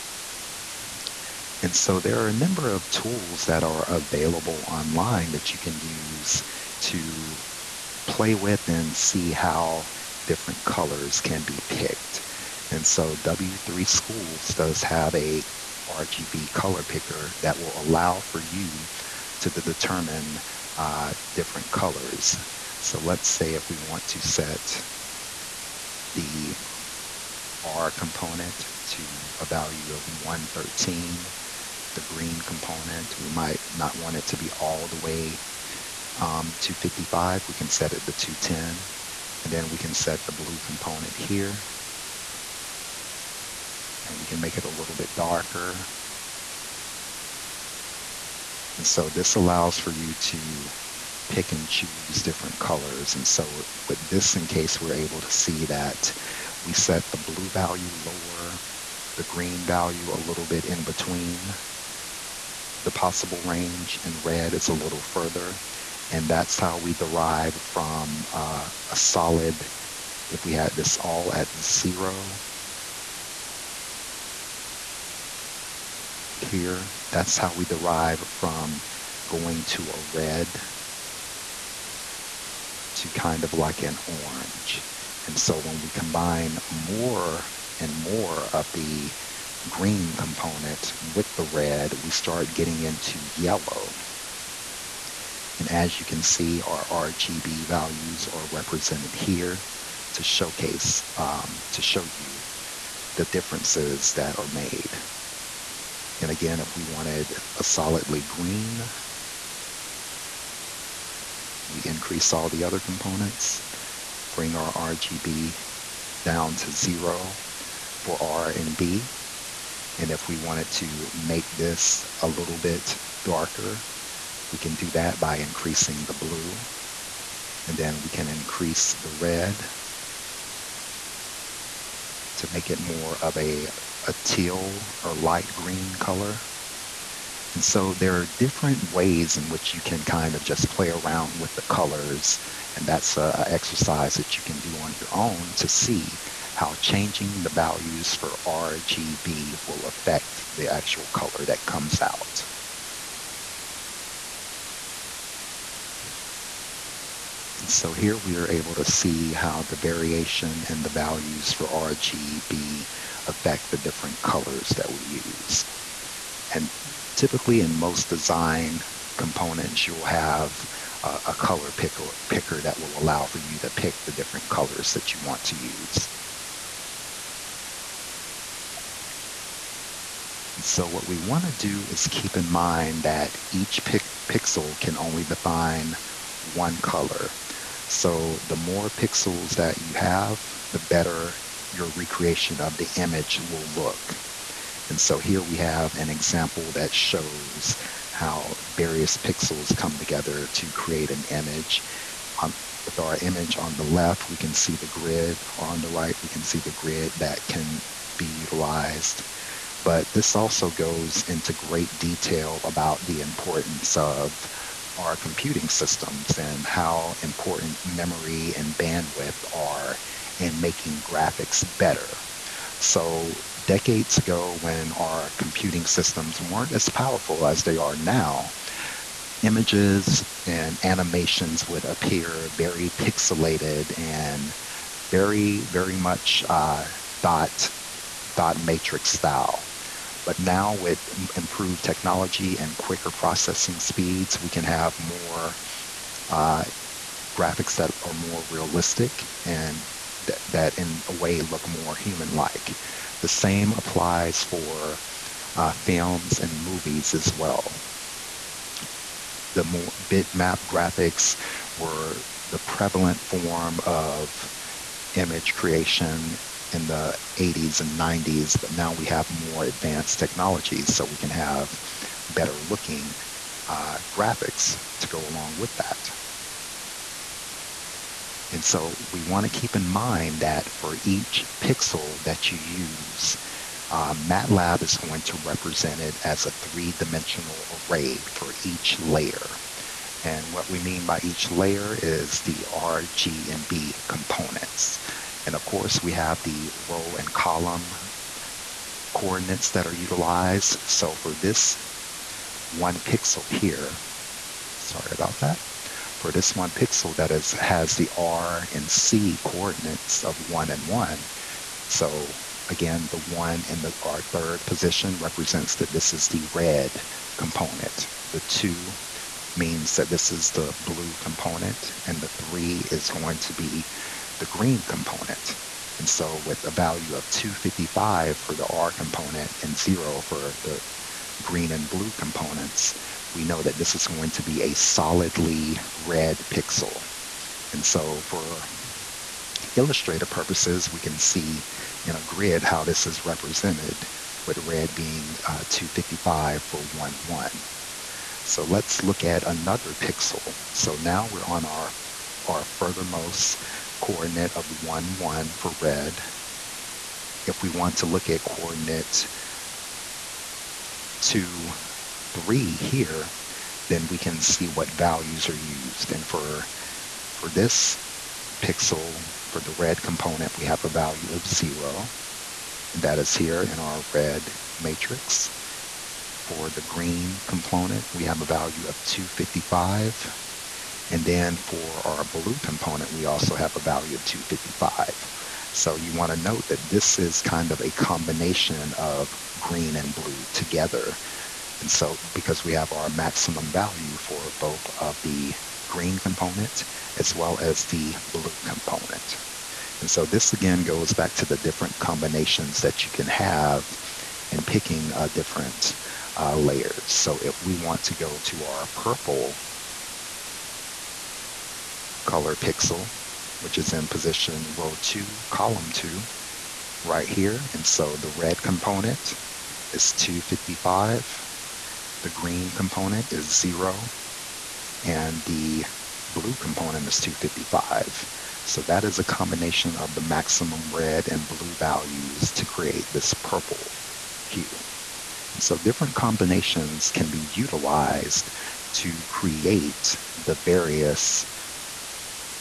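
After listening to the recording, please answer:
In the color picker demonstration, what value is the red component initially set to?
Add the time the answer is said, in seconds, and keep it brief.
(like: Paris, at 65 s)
113, at 30 s.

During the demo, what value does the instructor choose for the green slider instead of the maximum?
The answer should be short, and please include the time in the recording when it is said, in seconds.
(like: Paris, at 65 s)
210, at 38 s.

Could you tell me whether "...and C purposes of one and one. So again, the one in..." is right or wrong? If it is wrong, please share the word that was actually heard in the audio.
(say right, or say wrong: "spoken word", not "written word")
wrong: "coordinates", not "purposes".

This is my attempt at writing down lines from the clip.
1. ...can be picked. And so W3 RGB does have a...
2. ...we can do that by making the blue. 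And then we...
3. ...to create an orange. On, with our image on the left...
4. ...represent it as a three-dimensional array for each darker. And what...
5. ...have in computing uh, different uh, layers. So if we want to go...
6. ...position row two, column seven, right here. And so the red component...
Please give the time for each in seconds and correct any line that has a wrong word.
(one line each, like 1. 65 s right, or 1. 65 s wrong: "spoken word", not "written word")
1. 11 s wrong: "Schools", not "RGB"
2. 124 s wrong: "increasing", not "making"
3. 200 s wrong: "image", not "orange"
4. 285 s wrong: "layer", not "darker"
5. 403 s wrong: "picking", not "computing"
6. 414 s wrong: "two", not "seven".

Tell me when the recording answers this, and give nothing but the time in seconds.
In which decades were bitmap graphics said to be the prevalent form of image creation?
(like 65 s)
267 s.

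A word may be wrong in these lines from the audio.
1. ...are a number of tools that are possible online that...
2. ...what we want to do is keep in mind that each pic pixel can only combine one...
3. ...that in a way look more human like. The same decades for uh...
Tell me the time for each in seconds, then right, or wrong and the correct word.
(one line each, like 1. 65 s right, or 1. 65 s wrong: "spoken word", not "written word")
1. 2 s wrong: "available", not "possible"
2. 180 s wrong: "define", not "combine"
3. 250 s wrong: "applies", not "decades".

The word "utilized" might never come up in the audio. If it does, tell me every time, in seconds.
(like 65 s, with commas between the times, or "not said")
208 s, 299 s, 437 s.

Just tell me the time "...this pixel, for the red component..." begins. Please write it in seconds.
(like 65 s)
367 s.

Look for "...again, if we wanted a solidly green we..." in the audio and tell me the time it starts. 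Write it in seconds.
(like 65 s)
106 s.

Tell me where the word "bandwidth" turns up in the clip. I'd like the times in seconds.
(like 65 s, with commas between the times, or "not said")
218 s.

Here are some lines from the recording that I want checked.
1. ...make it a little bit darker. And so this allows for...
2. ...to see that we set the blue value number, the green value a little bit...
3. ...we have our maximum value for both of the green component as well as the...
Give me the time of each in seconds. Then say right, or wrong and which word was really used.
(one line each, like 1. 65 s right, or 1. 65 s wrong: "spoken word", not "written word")
1. 44 s right
2. 55 s wrong: "lower", not "number"
3. 392 s right.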